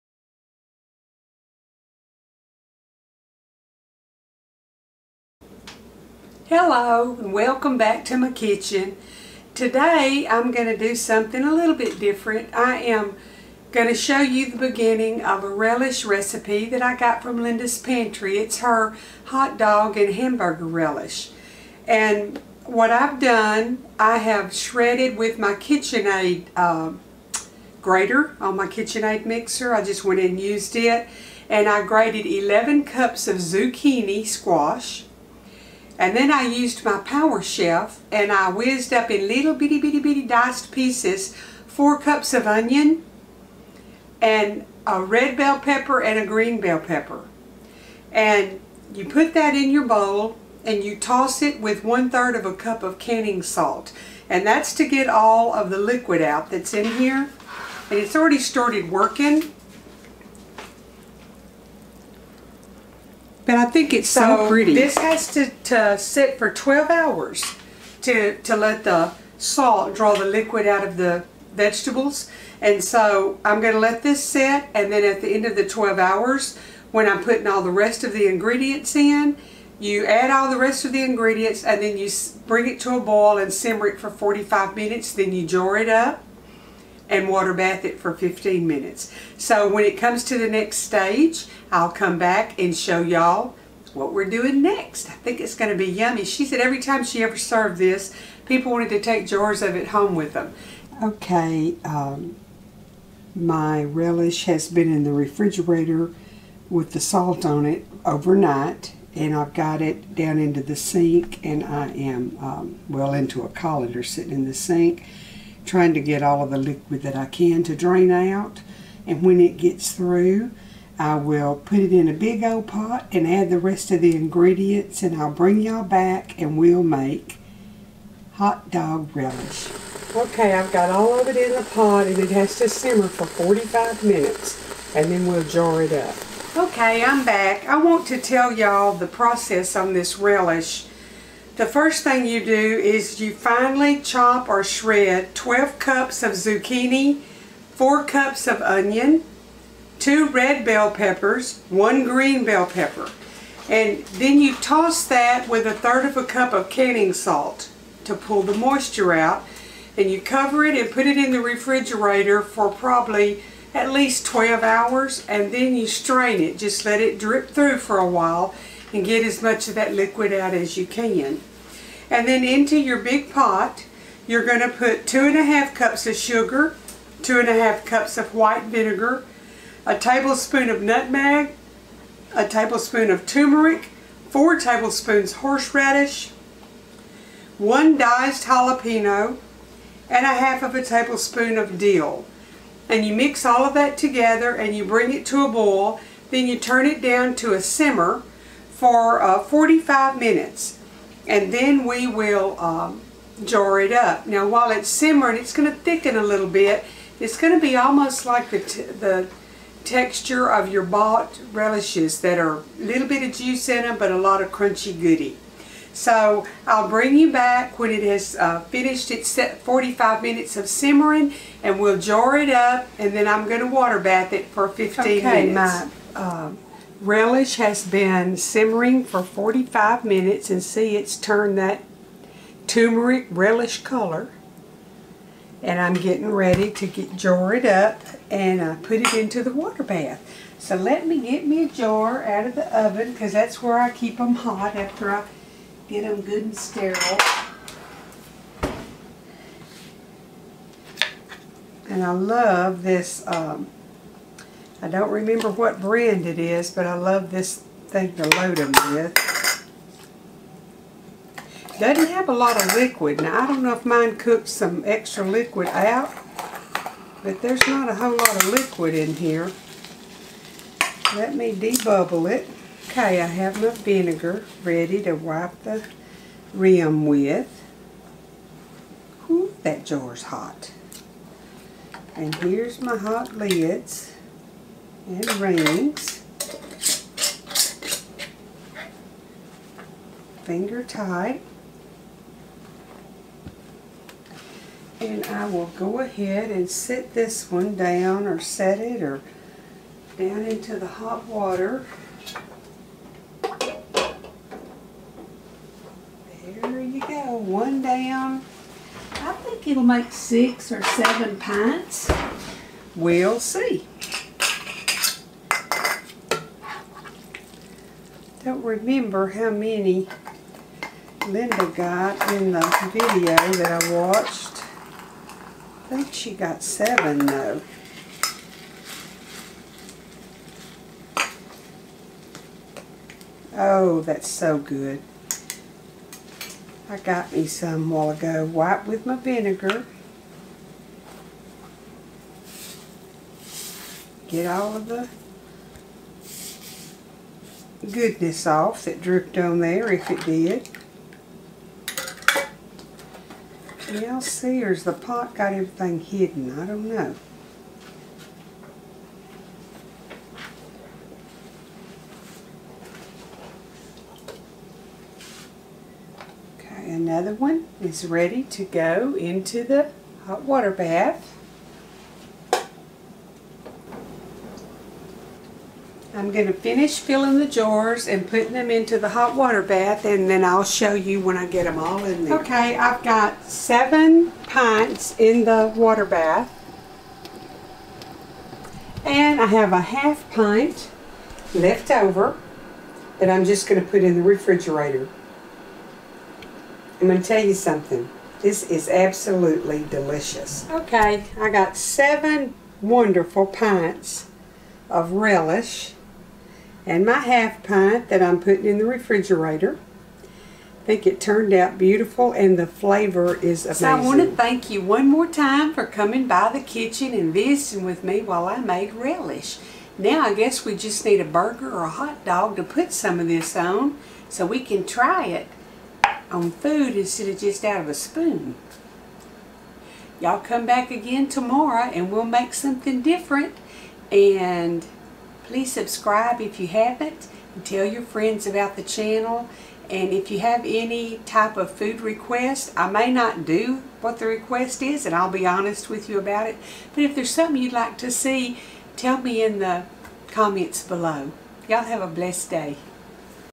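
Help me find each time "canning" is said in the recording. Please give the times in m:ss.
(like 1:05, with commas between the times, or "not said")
0:52, 2:36.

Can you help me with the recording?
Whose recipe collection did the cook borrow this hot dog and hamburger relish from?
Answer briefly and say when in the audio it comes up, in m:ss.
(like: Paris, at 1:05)
Linda's Pantry, at 0:17.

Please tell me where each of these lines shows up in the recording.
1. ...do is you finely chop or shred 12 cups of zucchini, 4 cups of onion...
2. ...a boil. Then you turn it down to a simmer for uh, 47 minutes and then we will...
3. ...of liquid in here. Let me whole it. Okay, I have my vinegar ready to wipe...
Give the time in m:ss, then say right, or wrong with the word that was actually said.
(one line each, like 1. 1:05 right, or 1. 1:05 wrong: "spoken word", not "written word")
1. 2:22 right
2. 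3:15 wrong: "45", not "47"
3. 4:28 wrong: "debubble", not "whole".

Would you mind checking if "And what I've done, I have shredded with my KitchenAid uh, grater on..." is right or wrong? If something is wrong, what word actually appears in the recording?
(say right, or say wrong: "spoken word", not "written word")
right.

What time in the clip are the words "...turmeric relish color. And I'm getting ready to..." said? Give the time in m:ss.
3:52.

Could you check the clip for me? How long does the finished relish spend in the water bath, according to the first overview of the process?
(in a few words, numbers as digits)
15 minutes.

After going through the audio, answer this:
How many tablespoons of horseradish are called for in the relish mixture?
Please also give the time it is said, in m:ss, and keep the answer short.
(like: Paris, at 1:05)
4, at 3:04.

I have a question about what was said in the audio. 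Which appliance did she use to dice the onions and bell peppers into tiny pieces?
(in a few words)
power chef.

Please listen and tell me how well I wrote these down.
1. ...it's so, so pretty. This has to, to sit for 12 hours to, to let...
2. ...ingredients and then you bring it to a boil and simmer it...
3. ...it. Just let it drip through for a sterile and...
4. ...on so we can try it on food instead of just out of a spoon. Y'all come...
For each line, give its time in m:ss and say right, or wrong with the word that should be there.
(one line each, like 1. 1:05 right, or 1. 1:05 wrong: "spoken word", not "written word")
1. 1:03 right
2. 1:21 right
3. 2:46 wrong: "while", not "sterile"
4. 7:03 right.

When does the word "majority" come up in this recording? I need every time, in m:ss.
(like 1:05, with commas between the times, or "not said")
not said.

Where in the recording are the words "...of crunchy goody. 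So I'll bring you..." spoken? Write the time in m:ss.
3:34.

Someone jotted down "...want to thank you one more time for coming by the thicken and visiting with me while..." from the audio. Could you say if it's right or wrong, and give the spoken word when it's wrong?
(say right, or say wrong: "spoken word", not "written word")
wrong: "kitchen", not "thicken".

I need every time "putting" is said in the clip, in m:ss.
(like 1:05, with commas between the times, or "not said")
1:17, 6:18, 6:48.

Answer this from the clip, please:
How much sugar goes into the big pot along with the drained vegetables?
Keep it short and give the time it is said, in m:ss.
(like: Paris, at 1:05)
2 1/2 cups, at 2:55.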